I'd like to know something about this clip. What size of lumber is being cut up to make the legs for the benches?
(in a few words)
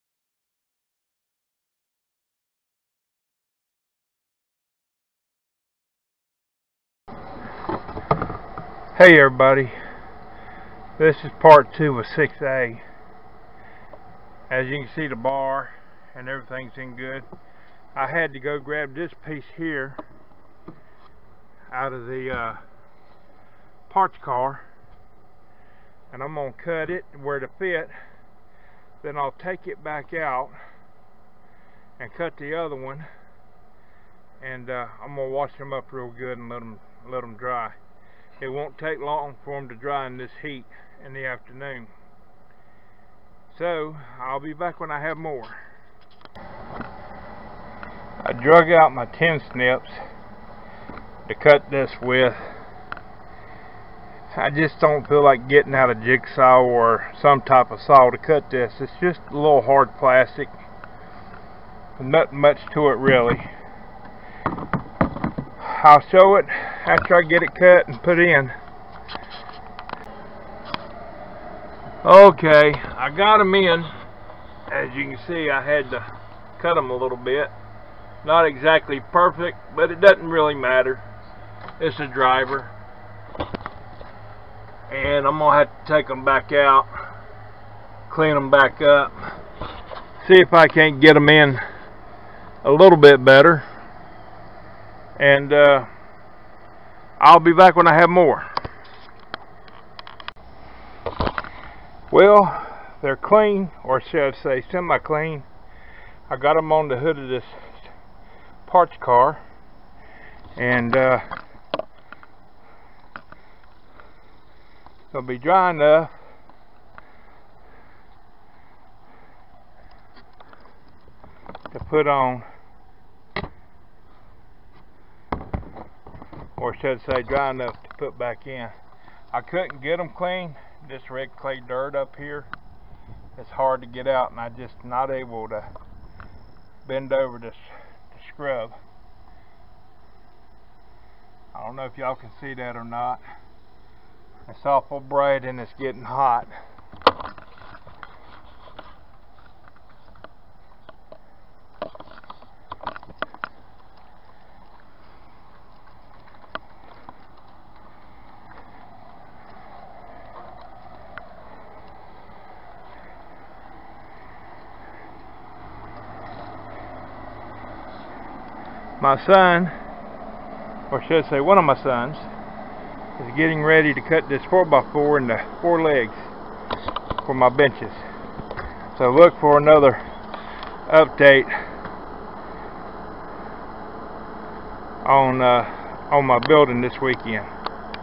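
4x4.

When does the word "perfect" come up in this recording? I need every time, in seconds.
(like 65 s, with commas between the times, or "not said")
79 s.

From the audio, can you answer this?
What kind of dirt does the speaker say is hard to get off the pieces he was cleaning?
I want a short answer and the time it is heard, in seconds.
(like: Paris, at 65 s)
red clay, at 131 s.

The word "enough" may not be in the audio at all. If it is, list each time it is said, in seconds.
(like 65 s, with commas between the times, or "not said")
115 s, 127 s.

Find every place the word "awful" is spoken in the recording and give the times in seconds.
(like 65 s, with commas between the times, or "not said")
144 s.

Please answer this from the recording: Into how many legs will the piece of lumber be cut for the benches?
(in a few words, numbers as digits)
4.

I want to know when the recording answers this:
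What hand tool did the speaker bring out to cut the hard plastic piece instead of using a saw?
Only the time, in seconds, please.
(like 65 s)
49 s.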